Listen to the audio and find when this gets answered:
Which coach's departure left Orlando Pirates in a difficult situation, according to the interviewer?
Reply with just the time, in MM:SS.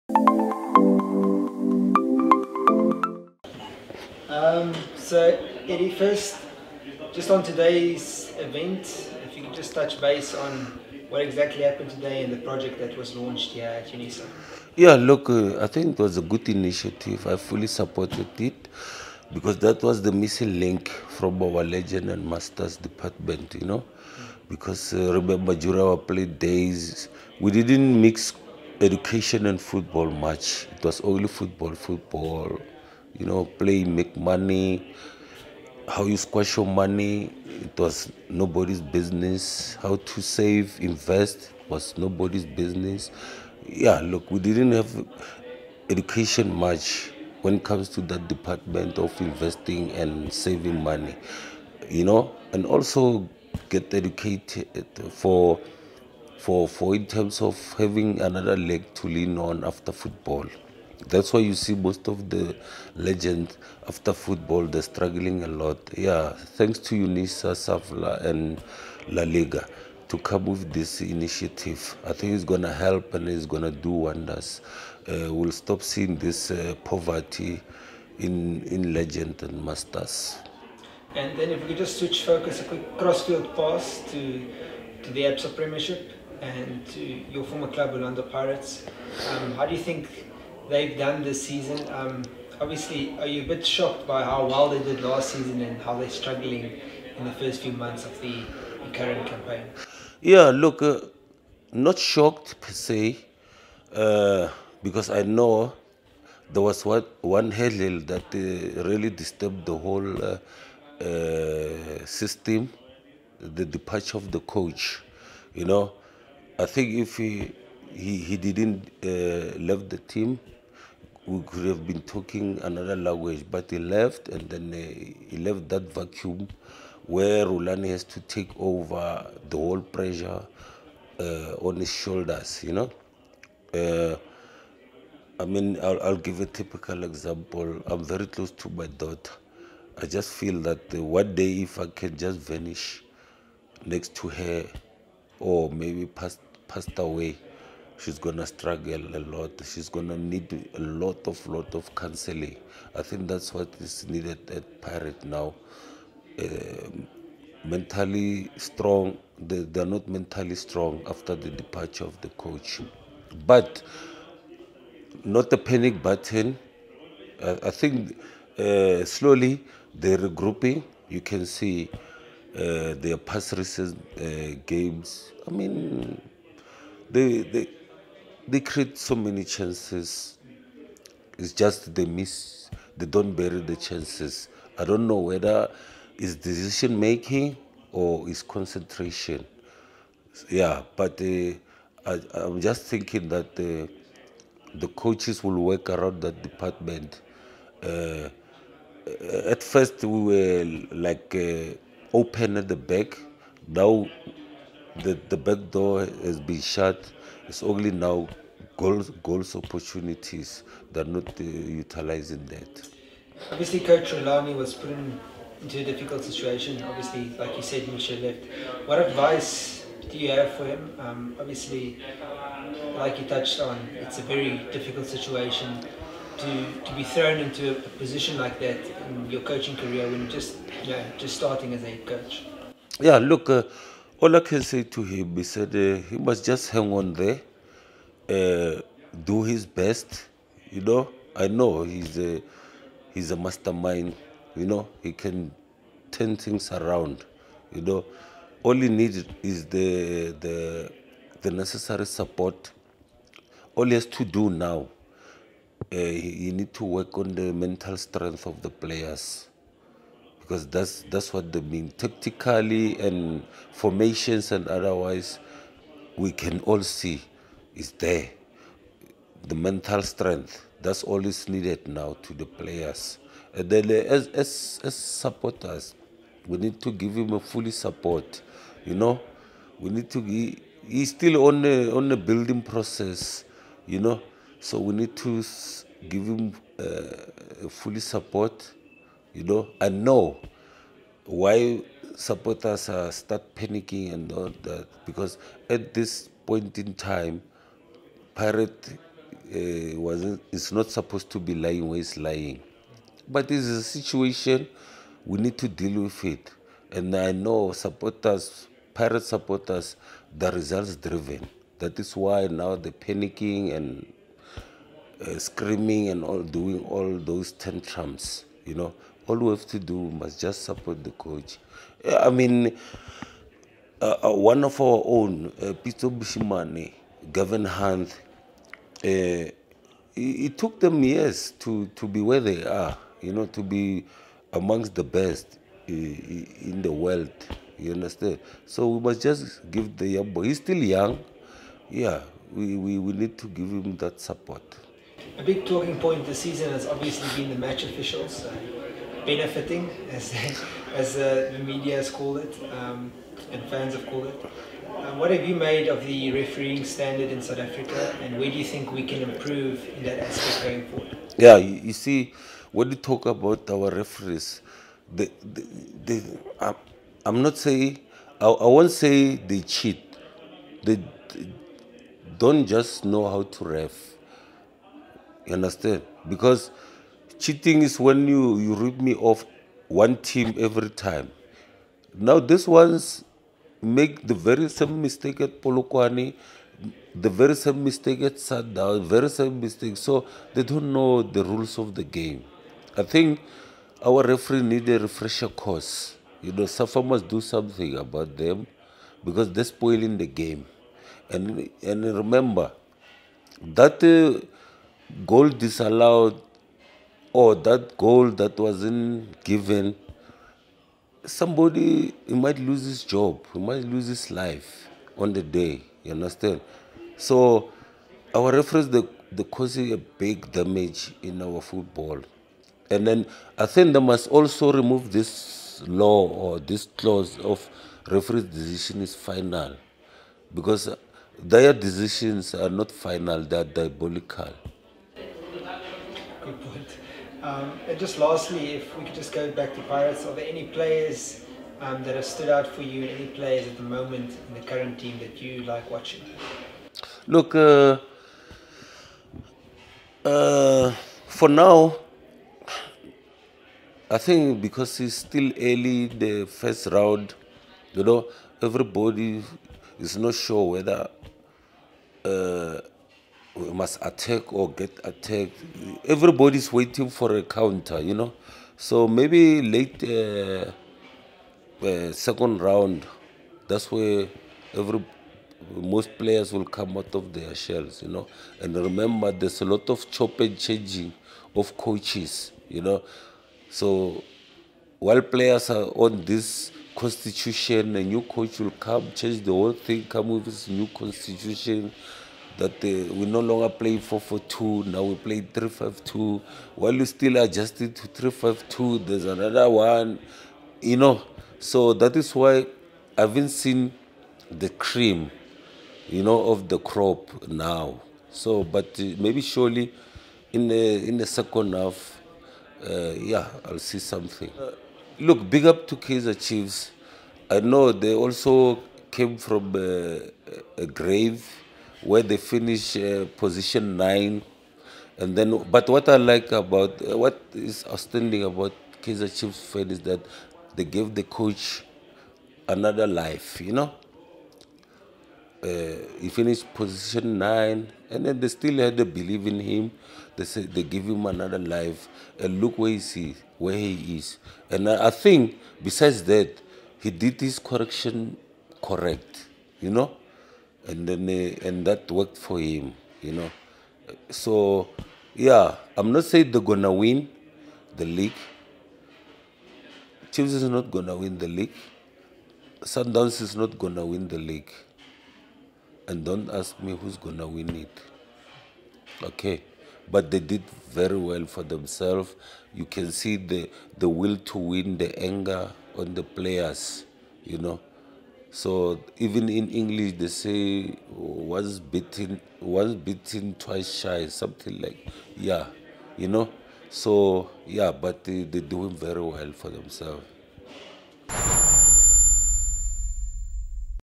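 03:37.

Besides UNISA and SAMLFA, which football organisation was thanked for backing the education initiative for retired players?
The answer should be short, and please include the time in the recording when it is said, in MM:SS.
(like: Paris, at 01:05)
La Liga, at 01:09.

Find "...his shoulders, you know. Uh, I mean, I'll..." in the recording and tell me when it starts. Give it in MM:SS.
02:11.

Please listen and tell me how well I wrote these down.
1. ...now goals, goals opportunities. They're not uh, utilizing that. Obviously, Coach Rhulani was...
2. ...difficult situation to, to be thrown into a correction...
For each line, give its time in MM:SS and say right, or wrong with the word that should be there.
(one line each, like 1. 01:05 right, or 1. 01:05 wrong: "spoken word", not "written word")
1. 03:27 right
2. 03:44 wrong: "position", not "correction".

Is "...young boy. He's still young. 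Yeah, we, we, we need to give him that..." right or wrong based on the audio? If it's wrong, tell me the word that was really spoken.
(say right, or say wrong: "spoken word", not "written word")
right.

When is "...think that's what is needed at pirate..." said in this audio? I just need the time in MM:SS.
02:33.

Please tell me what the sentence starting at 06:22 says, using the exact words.
Now these ones make the very same mistake at Polokwane, the very same mistake at Sada, very same mistake.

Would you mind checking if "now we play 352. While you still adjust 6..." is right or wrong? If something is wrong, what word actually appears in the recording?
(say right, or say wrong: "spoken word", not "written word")
wrong: "3", not "6".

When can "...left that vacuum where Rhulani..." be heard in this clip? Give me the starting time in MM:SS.
02:05.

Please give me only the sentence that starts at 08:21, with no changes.
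So that is why I haven't seen the cream, you know, of the crop now.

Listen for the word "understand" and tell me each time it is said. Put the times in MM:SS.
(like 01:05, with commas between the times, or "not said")
05:37, 06:15, 06:56.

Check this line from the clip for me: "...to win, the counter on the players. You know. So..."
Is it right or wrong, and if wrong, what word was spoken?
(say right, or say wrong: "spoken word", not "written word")
wrong: "anger", not "counter".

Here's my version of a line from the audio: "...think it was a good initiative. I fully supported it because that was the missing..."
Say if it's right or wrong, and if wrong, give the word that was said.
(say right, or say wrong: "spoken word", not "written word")
right.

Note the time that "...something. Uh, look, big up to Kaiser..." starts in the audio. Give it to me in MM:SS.
08:33.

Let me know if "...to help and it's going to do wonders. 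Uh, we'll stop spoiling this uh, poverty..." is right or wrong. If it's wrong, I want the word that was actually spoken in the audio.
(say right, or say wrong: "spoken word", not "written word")
wrong: "seeing", not "spoiling".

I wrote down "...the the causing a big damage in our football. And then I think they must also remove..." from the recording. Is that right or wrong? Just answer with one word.
right.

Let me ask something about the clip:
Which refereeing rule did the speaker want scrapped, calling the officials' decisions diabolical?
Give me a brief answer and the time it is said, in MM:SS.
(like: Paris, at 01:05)
referee decision is final, at 07:08.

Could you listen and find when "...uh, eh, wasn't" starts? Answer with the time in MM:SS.
04:59.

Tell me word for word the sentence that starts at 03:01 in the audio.
It's just they miss, they don't bury the chances.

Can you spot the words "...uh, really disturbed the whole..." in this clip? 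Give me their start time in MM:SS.
01:48.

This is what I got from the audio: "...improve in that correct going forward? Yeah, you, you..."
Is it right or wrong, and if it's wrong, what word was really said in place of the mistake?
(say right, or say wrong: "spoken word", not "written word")
wrong: "aspect", not "correct".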